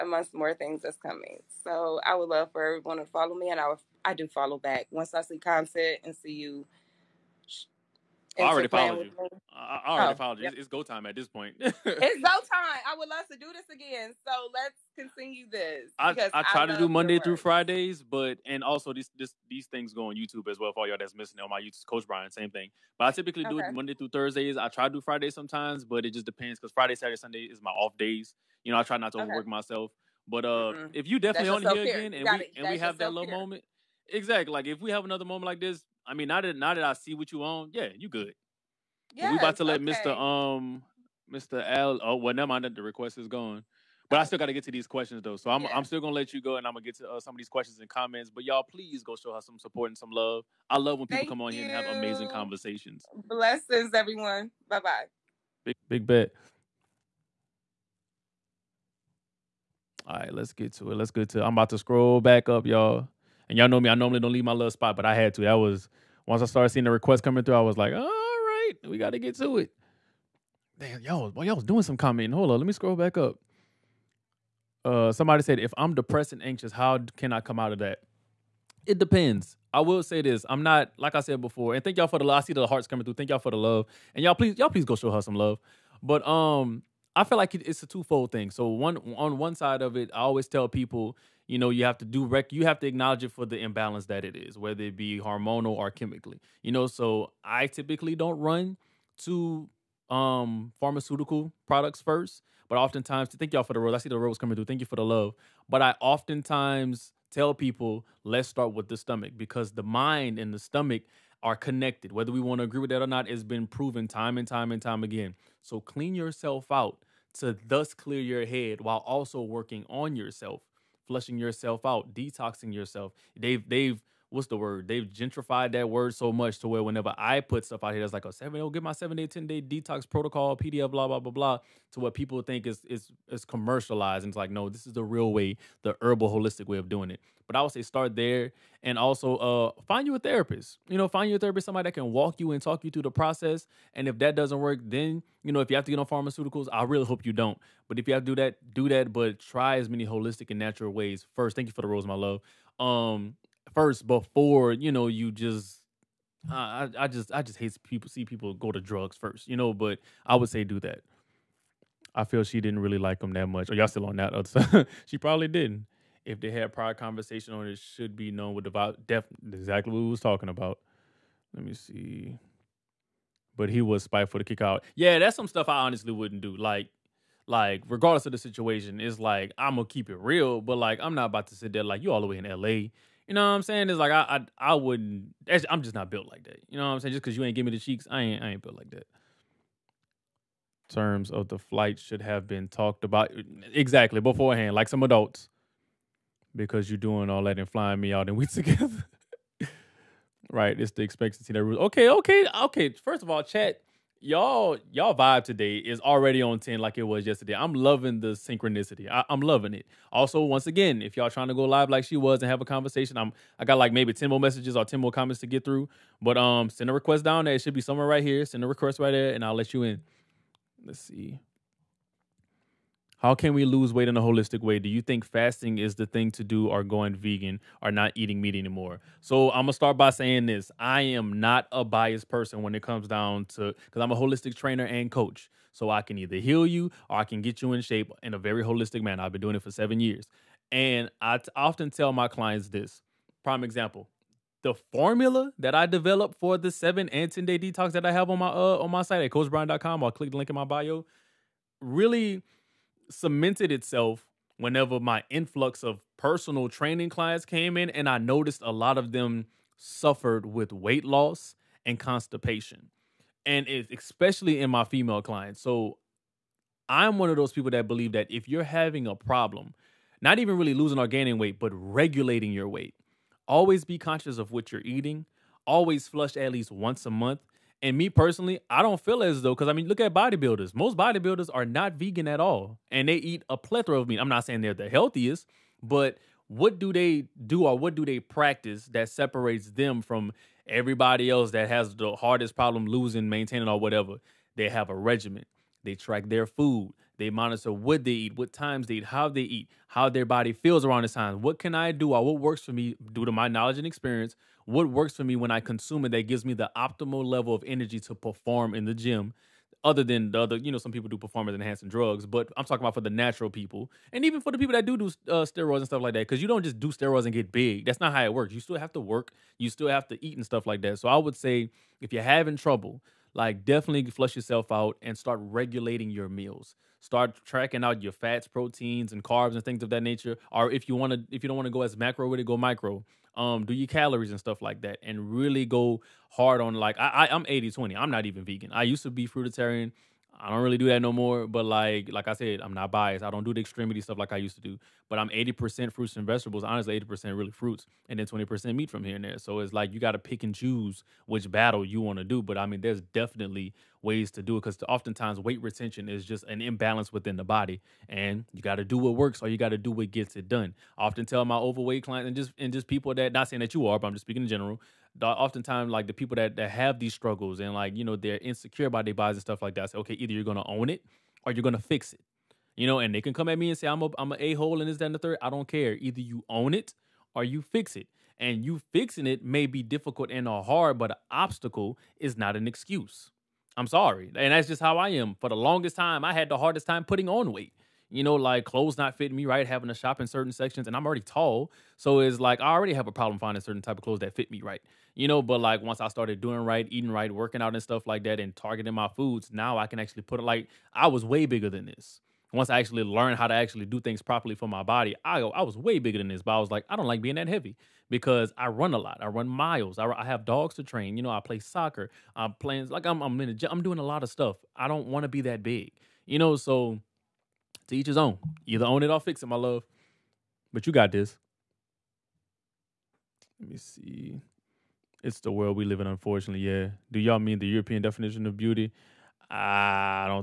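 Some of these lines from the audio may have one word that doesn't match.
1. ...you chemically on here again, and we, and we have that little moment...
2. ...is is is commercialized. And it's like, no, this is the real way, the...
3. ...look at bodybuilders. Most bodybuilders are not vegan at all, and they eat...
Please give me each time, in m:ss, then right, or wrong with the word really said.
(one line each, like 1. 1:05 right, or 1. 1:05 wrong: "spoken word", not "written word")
1. 0:31 wrong: "definitely", not "chemically"
2. 2:12 right
3. 4:39 right.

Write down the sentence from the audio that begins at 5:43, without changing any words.
I don't do the extremity stuff like I used to do.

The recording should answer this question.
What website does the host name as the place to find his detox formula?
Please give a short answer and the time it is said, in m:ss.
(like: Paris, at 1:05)
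coachbrine.com, at 4:09.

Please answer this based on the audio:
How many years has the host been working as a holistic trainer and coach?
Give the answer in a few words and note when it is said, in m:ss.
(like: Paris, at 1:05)
7, at 3:59.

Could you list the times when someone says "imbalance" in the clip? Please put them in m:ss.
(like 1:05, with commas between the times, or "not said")
1:33, 5:56.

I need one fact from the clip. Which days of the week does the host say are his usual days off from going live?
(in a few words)
Friday, Saturday, Sunday.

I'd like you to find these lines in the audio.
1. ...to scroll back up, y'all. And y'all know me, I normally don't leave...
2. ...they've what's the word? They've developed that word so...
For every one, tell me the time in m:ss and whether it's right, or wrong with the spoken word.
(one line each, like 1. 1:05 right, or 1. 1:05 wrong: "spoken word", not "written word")
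1. 1:01 right
2. 2:03 wrong: "gentrified", not "developed".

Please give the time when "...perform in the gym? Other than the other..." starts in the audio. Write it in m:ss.
5:08.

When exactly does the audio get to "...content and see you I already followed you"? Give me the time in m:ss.
0:05.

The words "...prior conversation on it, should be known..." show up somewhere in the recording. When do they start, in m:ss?
2:46.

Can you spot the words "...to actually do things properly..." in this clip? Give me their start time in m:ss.
6:43.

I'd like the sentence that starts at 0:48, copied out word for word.
But y'all, please go show her some support and some love.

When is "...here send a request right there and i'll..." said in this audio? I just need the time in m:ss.
3:38.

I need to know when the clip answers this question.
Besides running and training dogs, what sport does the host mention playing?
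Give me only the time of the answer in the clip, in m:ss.
6:51.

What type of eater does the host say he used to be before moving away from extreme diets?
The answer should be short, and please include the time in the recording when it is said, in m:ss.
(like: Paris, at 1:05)
Fruitarian, at 5:39.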